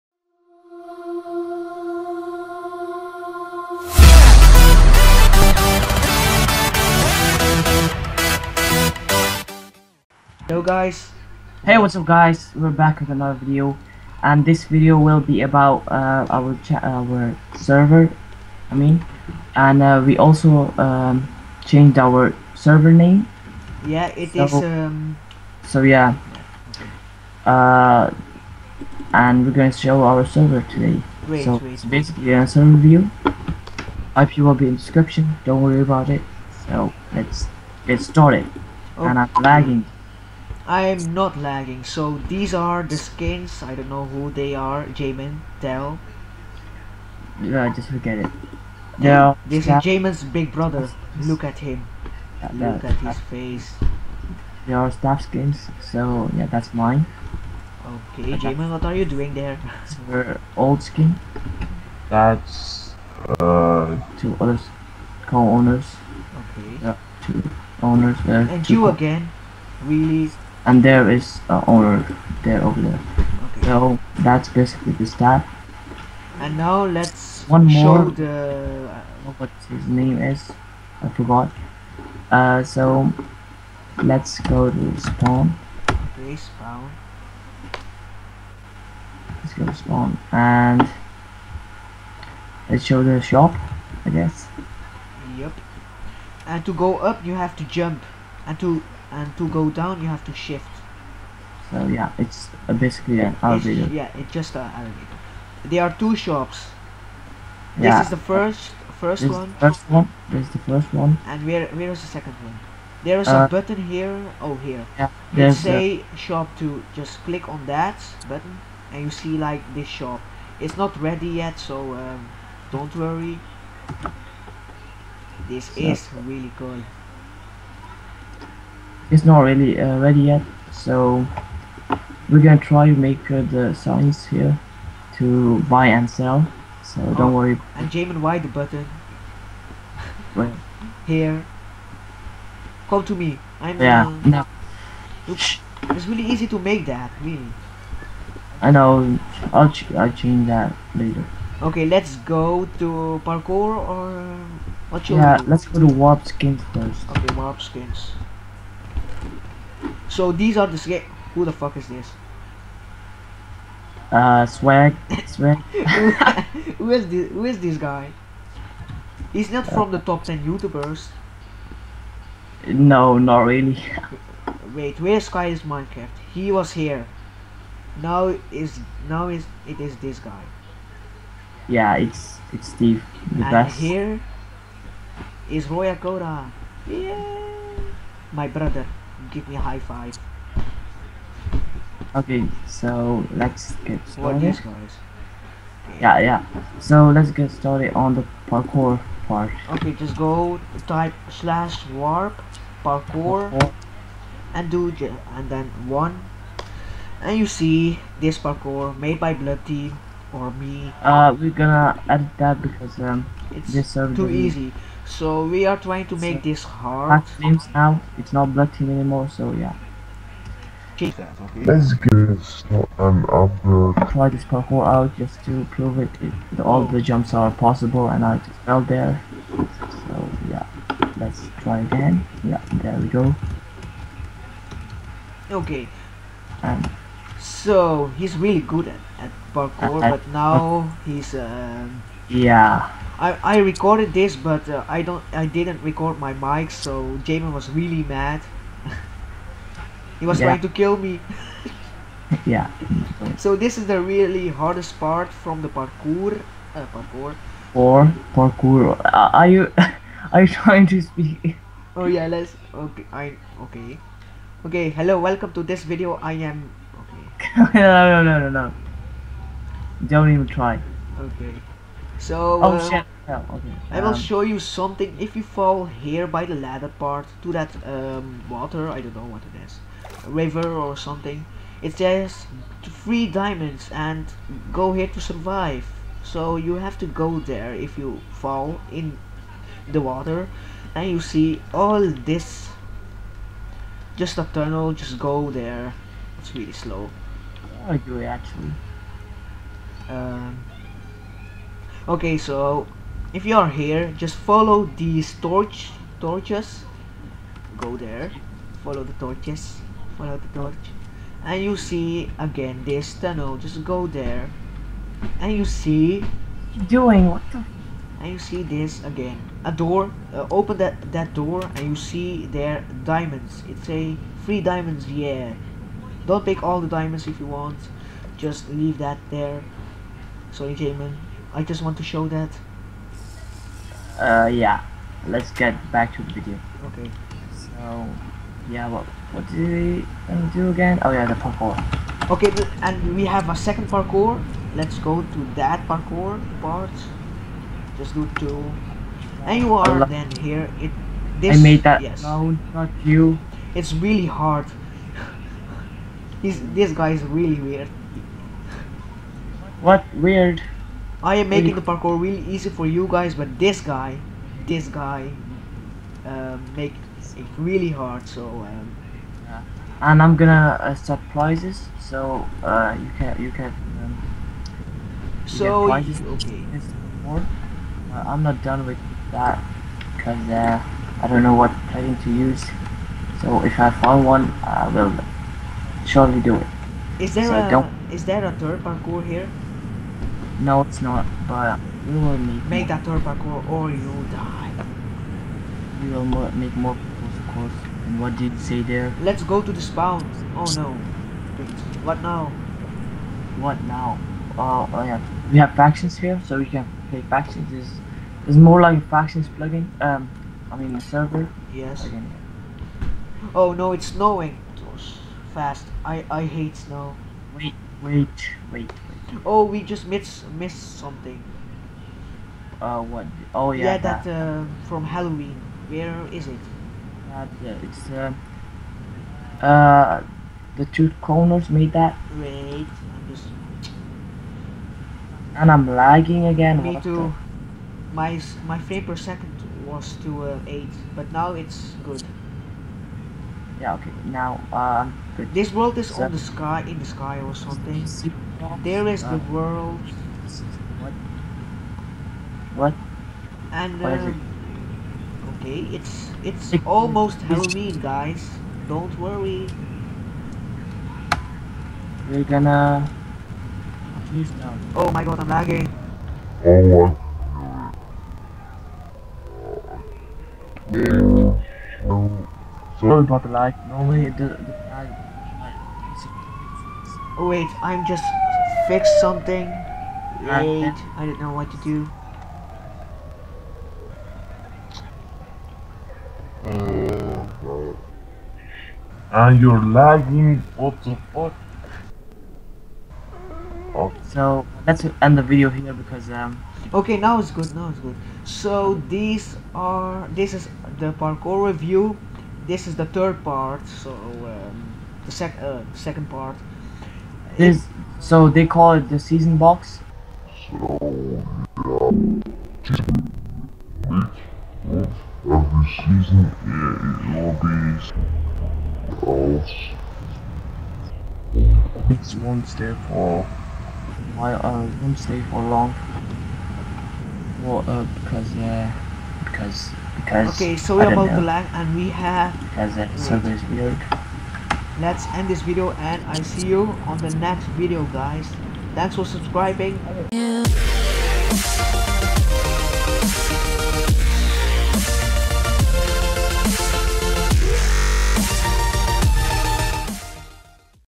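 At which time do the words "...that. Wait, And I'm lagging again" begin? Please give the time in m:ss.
7:11.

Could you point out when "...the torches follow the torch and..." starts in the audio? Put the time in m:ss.
5:09.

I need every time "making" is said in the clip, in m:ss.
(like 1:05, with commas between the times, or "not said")
6:01.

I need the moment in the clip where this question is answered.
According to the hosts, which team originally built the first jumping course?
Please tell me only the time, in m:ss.
3:29.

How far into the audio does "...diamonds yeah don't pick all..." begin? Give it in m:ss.
5:24.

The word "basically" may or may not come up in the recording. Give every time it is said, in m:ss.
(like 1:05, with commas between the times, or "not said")
0:31, 1:14, 1:42.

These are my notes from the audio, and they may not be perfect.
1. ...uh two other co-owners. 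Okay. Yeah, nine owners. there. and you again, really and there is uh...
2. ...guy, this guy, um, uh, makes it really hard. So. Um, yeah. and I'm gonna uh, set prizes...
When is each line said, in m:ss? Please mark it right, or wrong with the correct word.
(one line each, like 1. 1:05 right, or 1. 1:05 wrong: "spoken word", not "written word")
1. 1:03 wrong: "two", not "nine"
2. 6:03 right.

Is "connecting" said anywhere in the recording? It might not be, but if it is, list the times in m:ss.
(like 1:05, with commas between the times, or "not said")
not said.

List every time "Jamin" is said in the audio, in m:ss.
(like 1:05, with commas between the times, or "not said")
0:44, 0:49, 0:58, 2:17, 4:07, 5:30.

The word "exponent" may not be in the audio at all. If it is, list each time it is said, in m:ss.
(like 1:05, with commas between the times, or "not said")
not said.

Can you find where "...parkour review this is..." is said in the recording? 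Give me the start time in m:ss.
8:21.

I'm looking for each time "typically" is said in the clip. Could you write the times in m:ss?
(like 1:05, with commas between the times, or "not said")
not said.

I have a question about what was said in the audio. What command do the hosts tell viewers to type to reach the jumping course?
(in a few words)
/warp parkour.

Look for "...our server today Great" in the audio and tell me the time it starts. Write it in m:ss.
0:30.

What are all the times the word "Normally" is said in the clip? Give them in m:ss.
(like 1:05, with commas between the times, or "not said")
7:53.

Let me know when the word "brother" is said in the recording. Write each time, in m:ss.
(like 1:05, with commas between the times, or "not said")
0:50, 3:08.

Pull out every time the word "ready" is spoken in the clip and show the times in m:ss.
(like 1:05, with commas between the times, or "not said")
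2:01, 2:09.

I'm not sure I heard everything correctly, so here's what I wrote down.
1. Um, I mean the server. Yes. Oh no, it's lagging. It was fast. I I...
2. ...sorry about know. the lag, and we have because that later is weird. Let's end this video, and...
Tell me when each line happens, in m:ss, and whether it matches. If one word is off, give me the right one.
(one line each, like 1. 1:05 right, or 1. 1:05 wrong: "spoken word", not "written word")
1. 6:49 wrong: "snowing", not "lagging"
2. 8:50 wrong: "server", not "later".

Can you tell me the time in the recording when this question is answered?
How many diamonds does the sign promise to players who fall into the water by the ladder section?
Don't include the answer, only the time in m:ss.
4:42.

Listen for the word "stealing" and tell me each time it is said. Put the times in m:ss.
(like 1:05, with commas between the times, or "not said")
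not said.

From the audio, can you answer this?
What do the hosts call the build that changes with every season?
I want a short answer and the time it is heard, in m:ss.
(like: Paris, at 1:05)
Season box, at 8:29.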